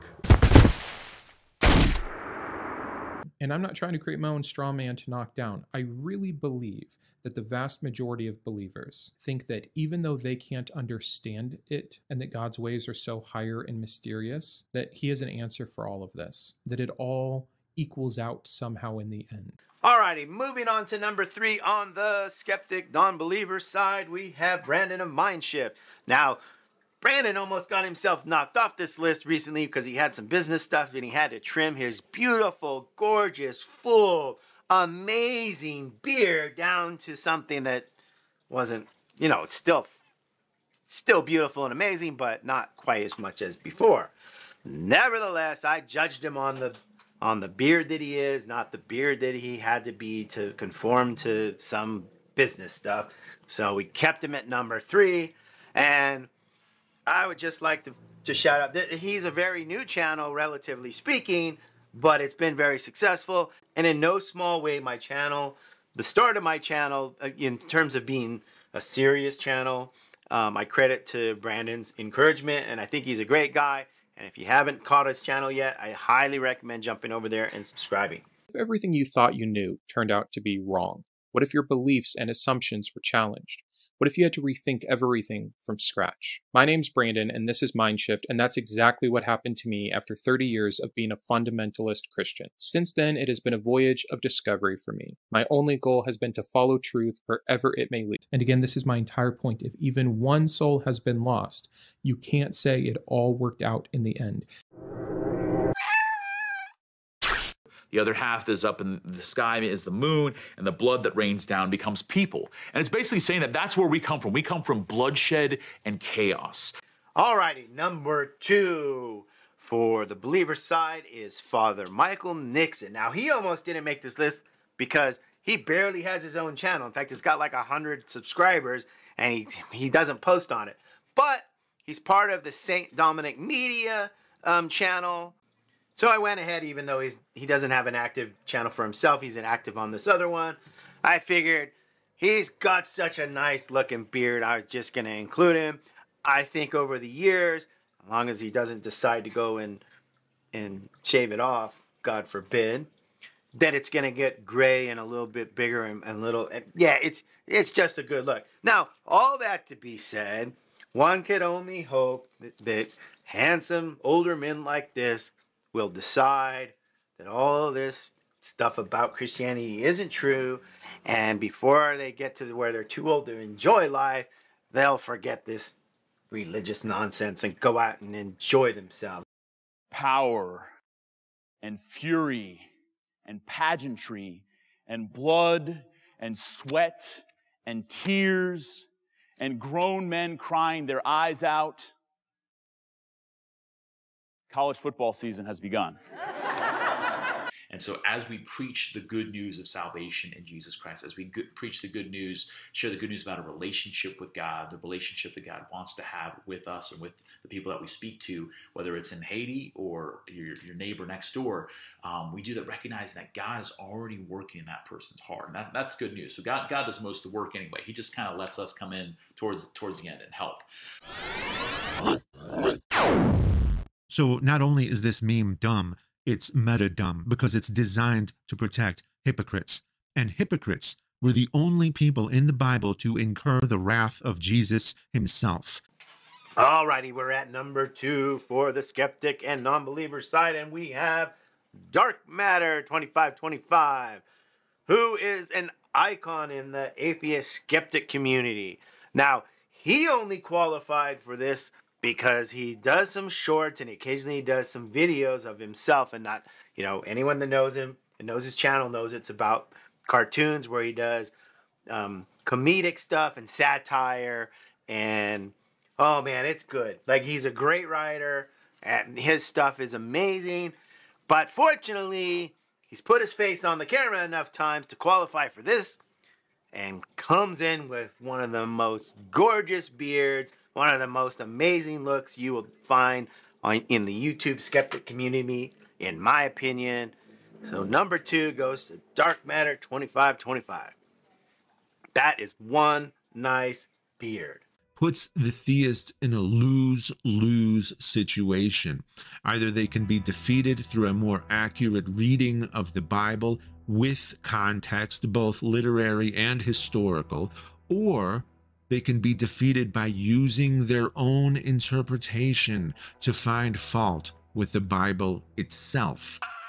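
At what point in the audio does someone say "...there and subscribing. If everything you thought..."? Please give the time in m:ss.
1:17.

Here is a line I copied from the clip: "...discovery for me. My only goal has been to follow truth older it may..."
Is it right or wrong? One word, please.
wrong.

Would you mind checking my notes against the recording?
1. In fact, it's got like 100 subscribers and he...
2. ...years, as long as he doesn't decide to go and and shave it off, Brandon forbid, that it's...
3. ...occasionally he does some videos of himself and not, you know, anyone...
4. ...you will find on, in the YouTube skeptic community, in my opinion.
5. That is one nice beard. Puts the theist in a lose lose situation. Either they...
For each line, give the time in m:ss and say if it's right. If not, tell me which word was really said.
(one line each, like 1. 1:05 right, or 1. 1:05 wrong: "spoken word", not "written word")
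1. 2:06 right
2. 2:27 wrong: "God", not "Brandon"
3. 4:13 right
4. 4:42 right
5. 4:52 right.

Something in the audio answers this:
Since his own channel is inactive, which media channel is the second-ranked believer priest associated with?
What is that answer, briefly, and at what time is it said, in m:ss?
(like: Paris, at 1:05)
St. Dominic Media, at 2:12.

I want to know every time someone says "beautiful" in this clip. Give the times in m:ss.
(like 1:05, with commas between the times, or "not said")
0:31, 0:41.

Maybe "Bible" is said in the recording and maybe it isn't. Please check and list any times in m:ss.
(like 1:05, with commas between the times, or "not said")
3:52, 5:03, 5:14.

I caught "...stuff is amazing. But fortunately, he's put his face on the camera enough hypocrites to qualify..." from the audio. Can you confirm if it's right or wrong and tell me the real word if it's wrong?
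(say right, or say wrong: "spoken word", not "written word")
wrong: "times", not "hypocrites".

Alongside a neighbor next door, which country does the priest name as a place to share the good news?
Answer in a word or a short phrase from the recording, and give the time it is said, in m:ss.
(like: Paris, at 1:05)
Haiti, at 3:29.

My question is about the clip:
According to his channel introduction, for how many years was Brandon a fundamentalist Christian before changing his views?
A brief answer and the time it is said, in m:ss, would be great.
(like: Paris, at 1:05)
30, at 1:30.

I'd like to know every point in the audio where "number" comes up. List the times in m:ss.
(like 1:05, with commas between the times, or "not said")
0:20, 0:54, 1:57, 3:57, 4:47.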